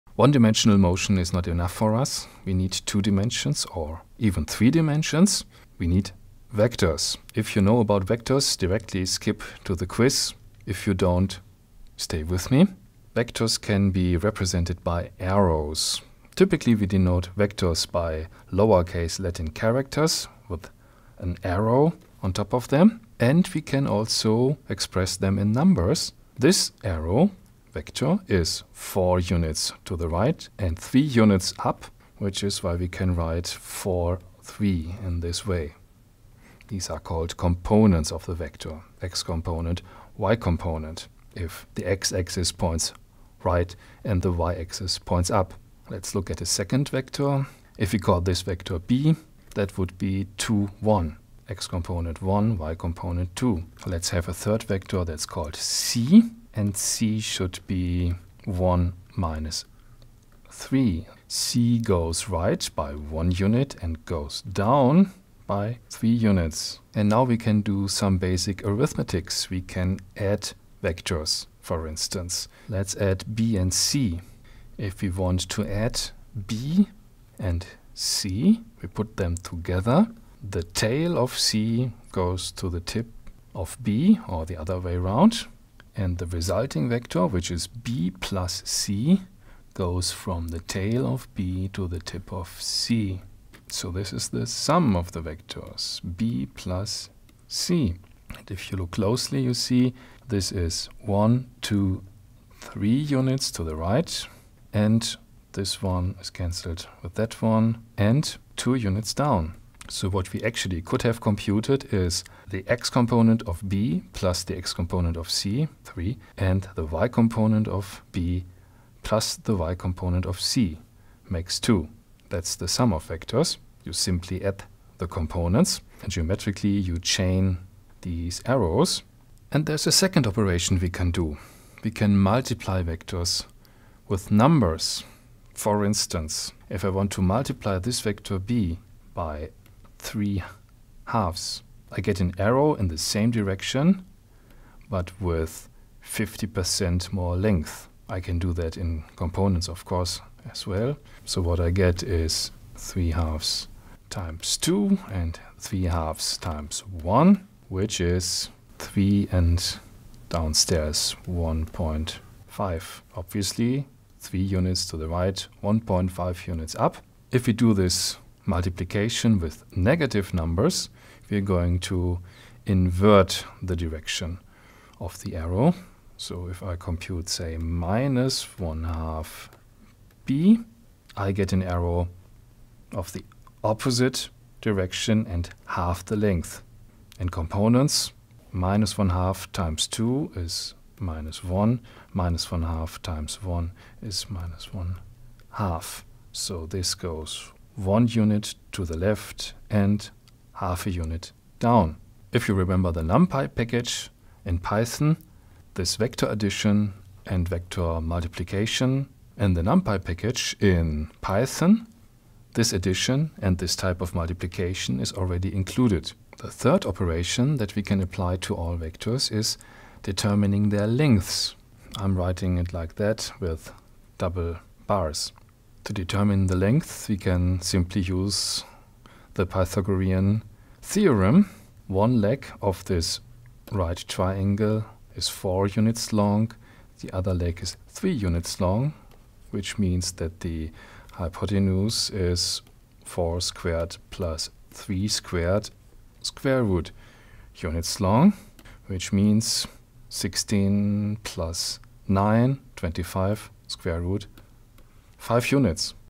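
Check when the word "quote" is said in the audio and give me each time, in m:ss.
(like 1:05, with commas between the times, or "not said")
not said.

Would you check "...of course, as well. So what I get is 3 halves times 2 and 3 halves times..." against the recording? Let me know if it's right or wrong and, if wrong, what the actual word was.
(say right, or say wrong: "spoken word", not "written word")
right.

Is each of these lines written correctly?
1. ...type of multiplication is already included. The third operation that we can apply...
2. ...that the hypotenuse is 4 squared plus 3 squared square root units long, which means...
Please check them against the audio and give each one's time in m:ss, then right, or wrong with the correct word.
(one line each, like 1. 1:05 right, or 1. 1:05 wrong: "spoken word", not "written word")
1. 3:33 right
2. 4:00 right.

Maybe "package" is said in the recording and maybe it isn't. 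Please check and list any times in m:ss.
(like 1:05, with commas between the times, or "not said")
3:23, 3:30.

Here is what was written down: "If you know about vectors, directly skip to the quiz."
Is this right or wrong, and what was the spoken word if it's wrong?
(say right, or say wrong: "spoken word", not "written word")
right.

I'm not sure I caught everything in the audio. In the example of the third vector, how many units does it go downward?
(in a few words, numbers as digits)
3.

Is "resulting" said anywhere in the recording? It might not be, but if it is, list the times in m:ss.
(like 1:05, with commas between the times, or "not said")
1:26.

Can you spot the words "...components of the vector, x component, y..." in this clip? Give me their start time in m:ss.
0:37.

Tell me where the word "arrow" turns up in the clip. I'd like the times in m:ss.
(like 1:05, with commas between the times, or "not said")
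0:15, 0:21, 0:26, 2:08, 2:22, 2:55, 3:01.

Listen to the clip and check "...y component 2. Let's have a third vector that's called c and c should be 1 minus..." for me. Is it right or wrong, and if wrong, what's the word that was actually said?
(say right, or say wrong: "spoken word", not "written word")
right.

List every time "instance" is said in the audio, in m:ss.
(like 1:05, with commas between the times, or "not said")
1:11, 2:15.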